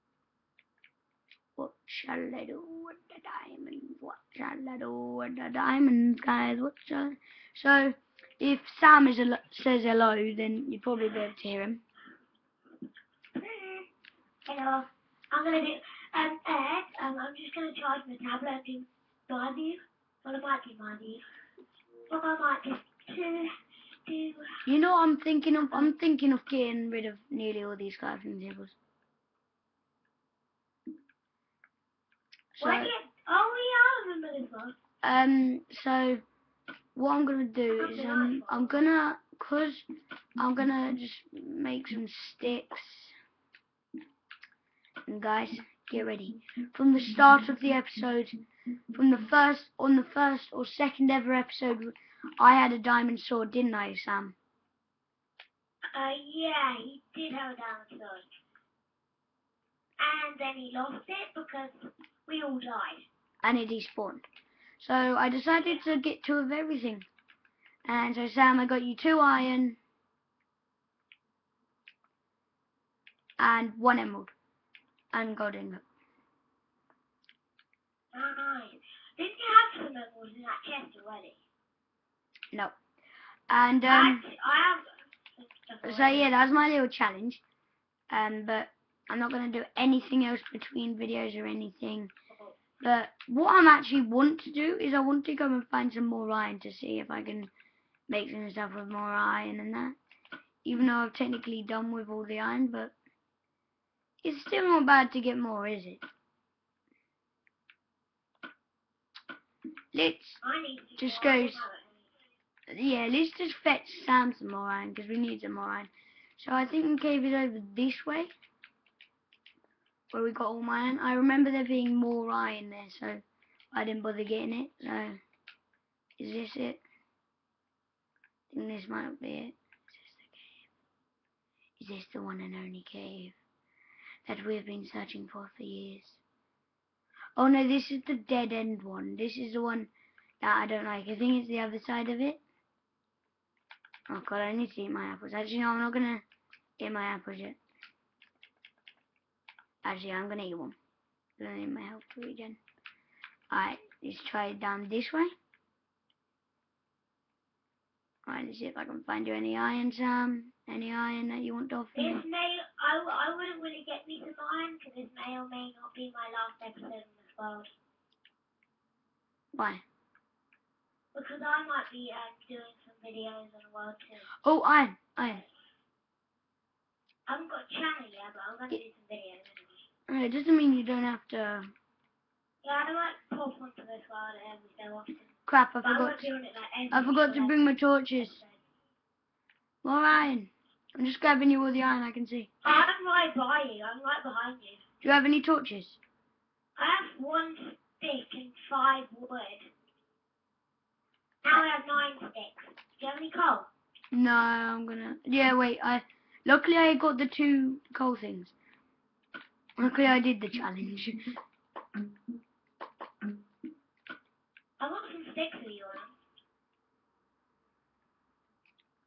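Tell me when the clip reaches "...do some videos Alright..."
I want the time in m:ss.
2:58.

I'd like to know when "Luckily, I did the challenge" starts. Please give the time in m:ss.
3:29.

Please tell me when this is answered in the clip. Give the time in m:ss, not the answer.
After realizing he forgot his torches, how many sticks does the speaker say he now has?
3:21.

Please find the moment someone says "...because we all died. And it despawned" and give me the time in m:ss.
1:01.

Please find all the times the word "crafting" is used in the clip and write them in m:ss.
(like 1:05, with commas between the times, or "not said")
0:27.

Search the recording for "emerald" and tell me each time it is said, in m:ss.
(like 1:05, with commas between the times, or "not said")
1:13, 1:19.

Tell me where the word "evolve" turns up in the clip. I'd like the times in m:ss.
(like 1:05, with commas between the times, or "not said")
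not said.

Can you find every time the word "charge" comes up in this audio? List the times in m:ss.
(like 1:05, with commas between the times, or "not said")
0:17.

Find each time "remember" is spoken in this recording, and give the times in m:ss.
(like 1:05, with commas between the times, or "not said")
0:34, 2:01.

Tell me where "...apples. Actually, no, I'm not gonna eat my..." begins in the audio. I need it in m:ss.
2:25.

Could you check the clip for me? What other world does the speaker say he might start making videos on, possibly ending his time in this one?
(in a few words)
World 2.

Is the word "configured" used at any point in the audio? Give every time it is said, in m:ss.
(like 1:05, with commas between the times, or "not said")
not said.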